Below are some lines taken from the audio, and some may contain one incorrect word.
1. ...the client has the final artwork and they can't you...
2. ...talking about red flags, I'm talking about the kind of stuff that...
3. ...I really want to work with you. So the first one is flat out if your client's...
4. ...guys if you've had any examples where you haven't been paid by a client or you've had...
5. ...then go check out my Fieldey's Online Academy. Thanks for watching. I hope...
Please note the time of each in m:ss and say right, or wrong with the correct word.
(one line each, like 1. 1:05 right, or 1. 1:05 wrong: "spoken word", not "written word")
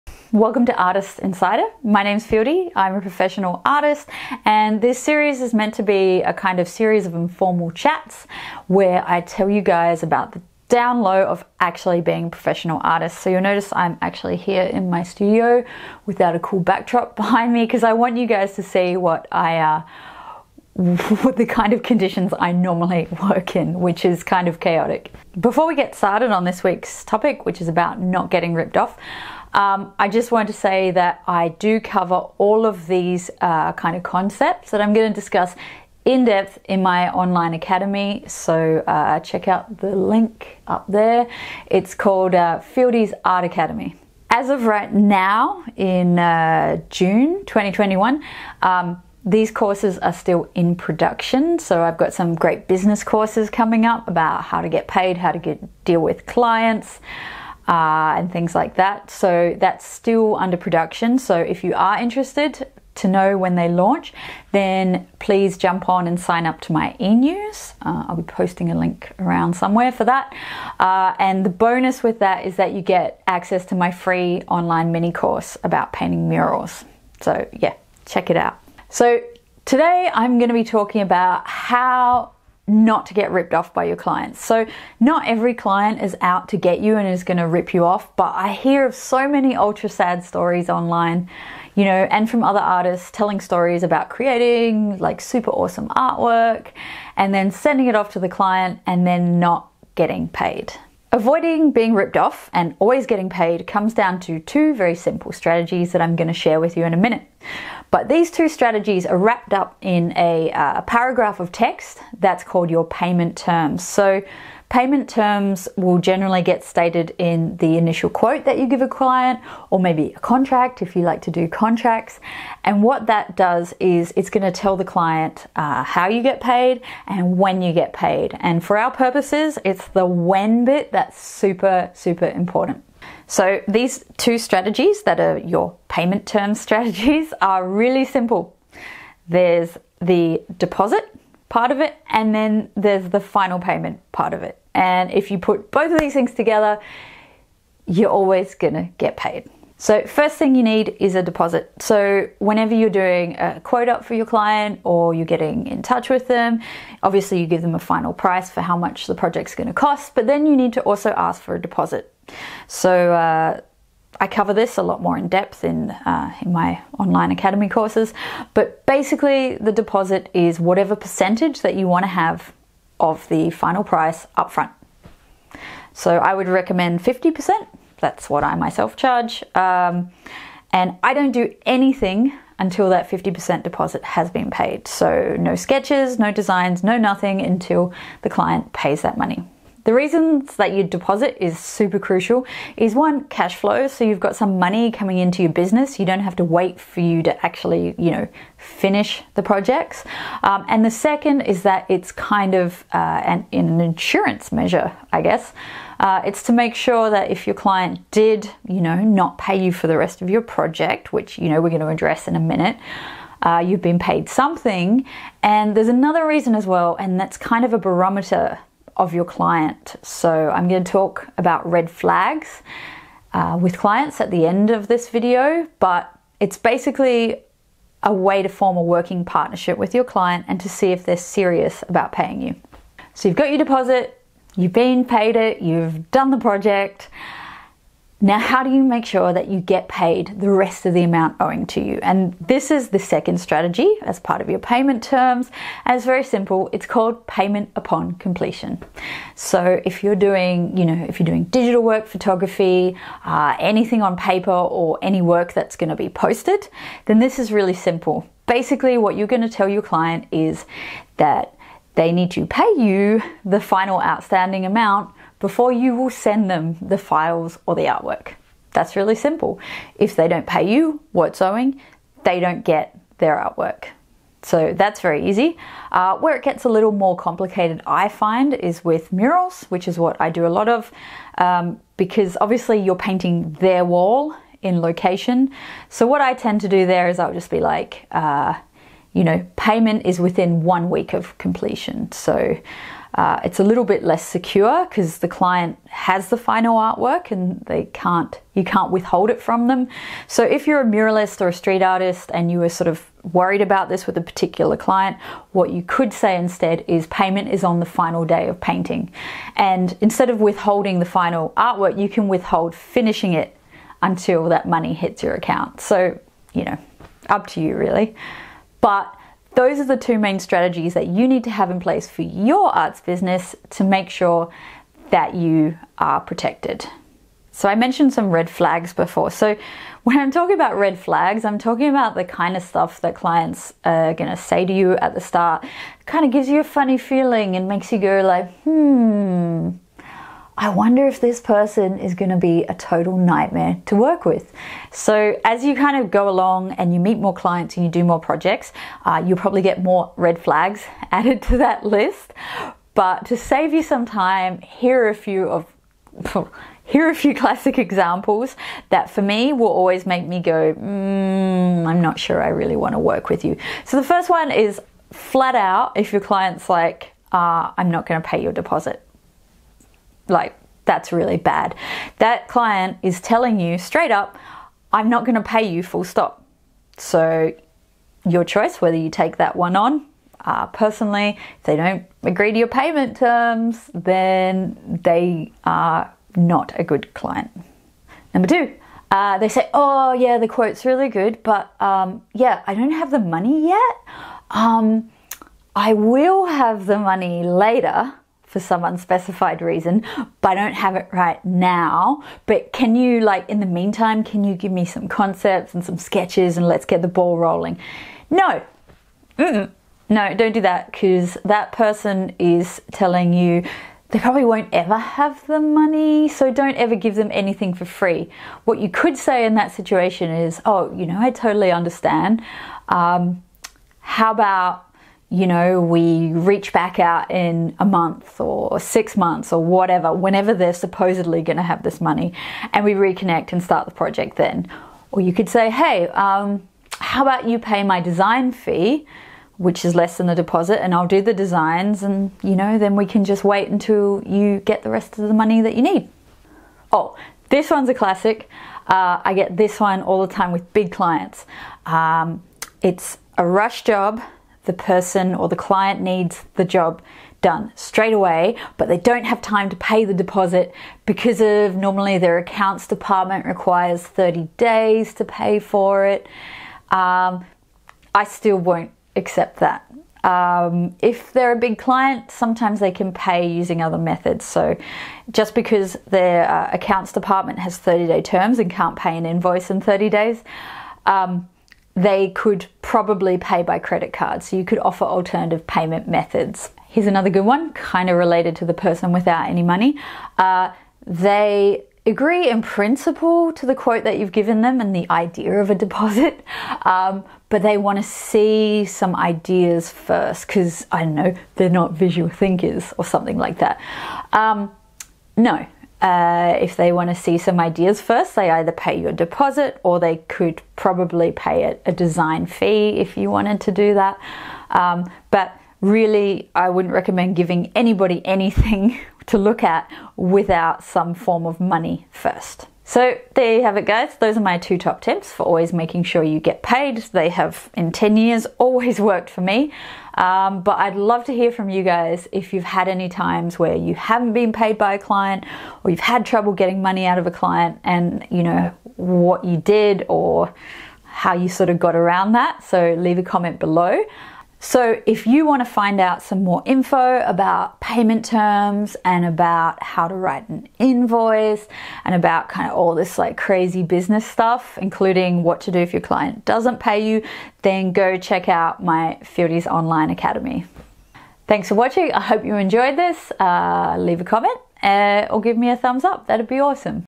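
1. 4:55 right
2. 5:30 right
3. 6:02 right
4. 8:51 wrong: "times", not "examples"
5. 9:17 right.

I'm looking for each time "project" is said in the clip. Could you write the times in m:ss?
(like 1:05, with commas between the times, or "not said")
2:39, 3:19, 3:30, 3:56, 5:48, 7:13.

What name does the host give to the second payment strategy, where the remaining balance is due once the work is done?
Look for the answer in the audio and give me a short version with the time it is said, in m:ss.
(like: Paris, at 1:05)
Payment upon completion, at 4:07.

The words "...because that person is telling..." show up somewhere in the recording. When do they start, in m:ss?
6:50.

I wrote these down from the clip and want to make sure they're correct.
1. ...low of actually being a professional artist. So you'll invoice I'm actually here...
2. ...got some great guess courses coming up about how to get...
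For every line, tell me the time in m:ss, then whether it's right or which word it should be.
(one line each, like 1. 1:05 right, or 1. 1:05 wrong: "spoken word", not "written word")
1. 0:11 wrong: "notice", not "invoice"
2. 0:51 wrong: "business", not "guess".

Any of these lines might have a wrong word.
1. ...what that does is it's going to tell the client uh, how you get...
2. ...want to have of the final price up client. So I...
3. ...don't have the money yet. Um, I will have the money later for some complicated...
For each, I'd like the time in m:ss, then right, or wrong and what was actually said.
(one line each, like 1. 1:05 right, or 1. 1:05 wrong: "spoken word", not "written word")
1. 2:02 right
2. 2:51 wrong: "front", not "client"
3. 6:32 wrong: "unspecified", not "complicated".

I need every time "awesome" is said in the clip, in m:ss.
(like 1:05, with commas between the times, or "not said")
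1:35, 9:26.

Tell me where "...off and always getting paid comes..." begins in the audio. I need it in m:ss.
1:42.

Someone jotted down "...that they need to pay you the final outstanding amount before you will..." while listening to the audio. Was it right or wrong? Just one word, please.
right.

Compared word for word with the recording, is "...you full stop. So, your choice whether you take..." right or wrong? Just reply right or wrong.
right.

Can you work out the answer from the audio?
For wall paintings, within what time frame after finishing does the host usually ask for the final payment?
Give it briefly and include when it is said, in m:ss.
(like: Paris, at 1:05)
One week, at 4:50.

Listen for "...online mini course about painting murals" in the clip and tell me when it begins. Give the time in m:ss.
1:14.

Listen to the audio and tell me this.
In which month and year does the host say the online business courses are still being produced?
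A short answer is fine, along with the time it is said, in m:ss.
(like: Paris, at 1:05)
June 2021, at 0:46.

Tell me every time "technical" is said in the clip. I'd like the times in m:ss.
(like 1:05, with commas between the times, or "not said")
not said.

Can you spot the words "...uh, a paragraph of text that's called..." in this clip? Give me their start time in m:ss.
1:50.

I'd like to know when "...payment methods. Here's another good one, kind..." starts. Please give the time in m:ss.
8:05.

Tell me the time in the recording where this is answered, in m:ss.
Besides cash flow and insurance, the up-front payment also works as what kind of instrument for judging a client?
3:37.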